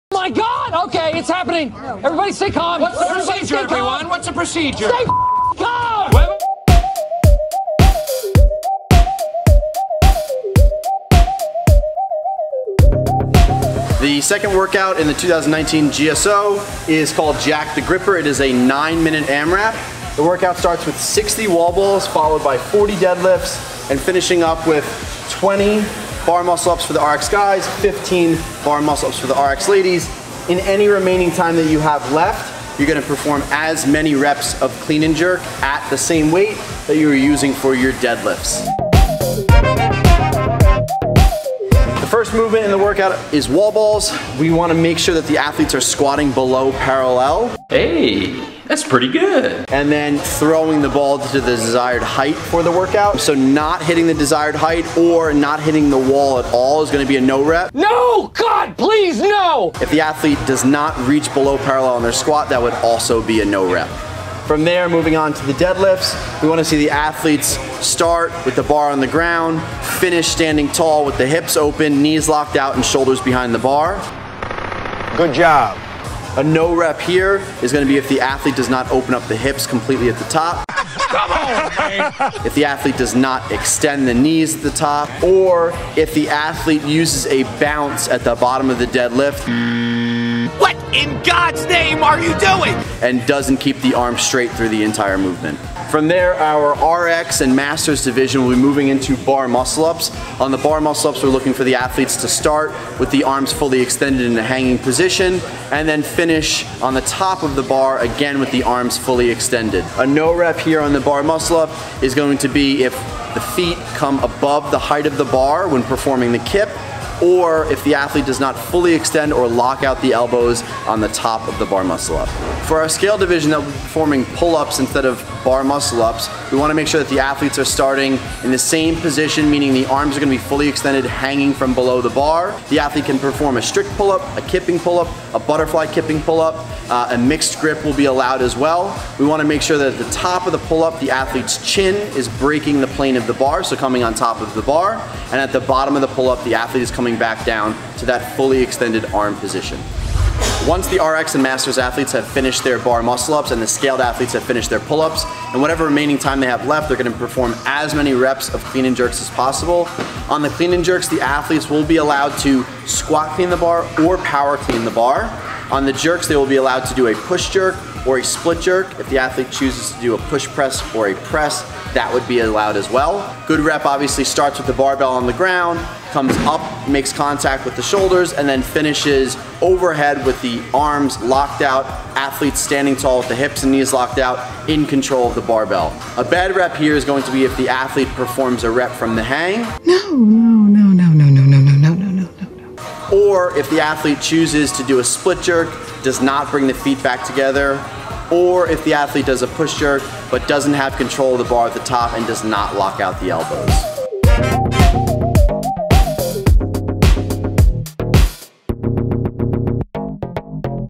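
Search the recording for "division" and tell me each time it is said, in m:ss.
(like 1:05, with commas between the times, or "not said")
1:38, 2:03.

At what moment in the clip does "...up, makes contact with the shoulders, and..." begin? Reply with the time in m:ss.
2:56.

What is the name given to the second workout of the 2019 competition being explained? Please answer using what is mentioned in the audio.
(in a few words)
Jack the Gripper.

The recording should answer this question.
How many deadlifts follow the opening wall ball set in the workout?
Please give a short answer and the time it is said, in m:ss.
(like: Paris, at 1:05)
40, at 0:22.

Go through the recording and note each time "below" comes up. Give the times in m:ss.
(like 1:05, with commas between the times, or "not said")
0:46, 1:01, 2:11.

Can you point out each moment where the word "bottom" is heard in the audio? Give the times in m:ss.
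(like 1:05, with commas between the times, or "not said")
1:28, 2:25.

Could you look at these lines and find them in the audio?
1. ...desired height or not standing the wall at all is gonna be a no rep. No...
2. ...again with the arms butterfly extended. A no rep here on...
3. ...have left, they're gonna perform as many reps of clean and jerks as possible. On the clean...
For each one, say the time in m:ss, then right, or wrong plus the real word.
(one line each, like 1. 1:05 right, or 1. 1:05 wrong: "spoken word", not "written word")
1. 0:54 wrong: "hitting", not "standing"
2. 1:47 wrong: "fully", not "butterfly"
3. 2:36 right.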